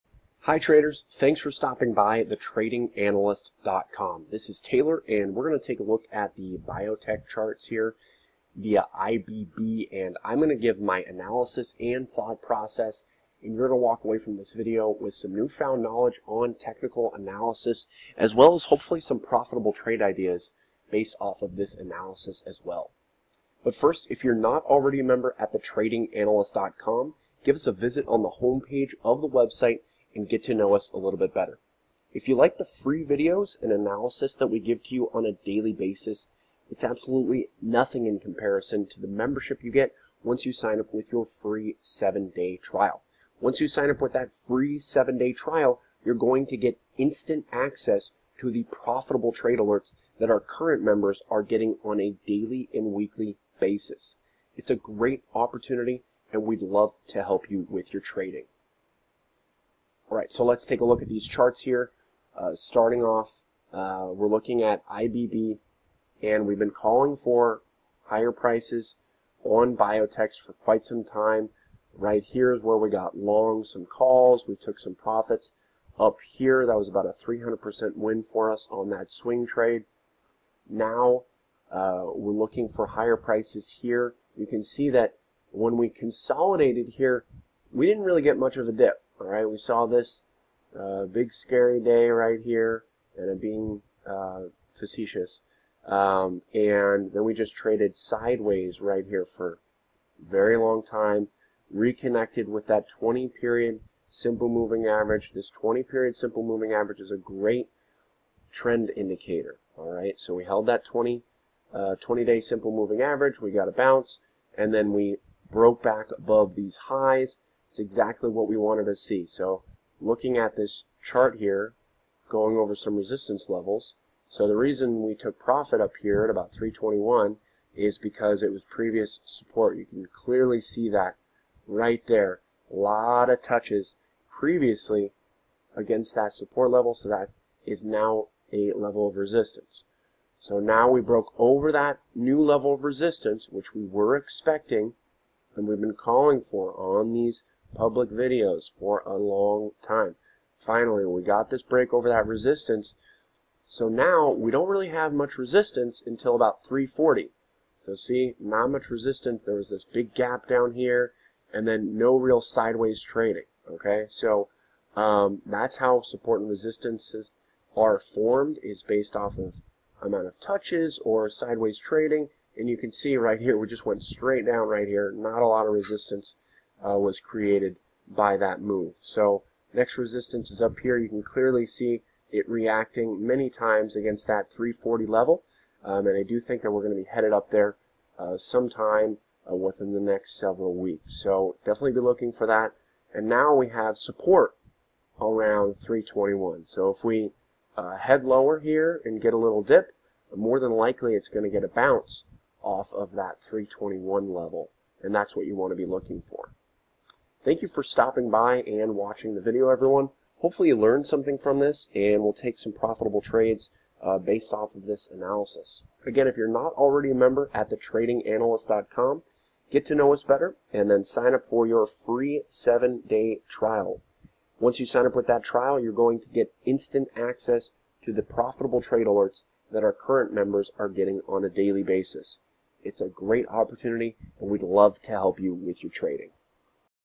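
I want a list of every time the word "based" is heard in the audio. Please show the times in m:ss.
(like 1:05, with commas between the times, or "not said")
0:20, 2:48, 3:34.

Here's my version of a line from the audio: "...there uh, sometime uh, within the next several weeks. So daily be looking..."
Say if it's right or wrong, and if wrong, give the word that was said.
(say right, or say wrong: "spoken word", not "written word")
wrong: "definitely", not "daily".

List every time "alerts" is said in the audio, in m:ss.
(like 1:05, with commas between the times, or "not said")
0:49, 3:49.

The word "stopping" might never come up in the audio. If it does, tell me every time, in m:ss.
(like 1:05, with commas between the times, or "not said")
0:01, 3:27.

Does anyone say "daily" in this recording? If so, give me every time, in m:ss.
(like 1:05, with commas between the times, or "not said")
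0:35, 0:52, 3:51.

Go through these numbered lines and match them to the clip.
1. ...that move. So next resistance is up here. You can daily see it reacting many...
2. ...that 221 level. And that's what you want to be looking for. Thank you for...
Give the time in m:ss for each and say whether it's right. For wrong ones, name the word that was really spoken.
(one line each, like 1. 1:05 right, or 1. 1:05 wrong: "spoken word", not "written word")
1. 2:58 wrong: "clearly", not "daily"
2. 3:23 wrong: "321", not "221".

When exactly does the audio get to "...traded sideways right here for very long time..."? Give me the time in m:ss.
1:37.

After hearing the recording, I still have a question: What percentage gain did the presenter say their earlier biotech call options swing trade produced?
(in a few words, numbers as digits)
300%.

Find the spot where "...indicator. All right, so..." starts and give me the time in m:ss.
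1:48.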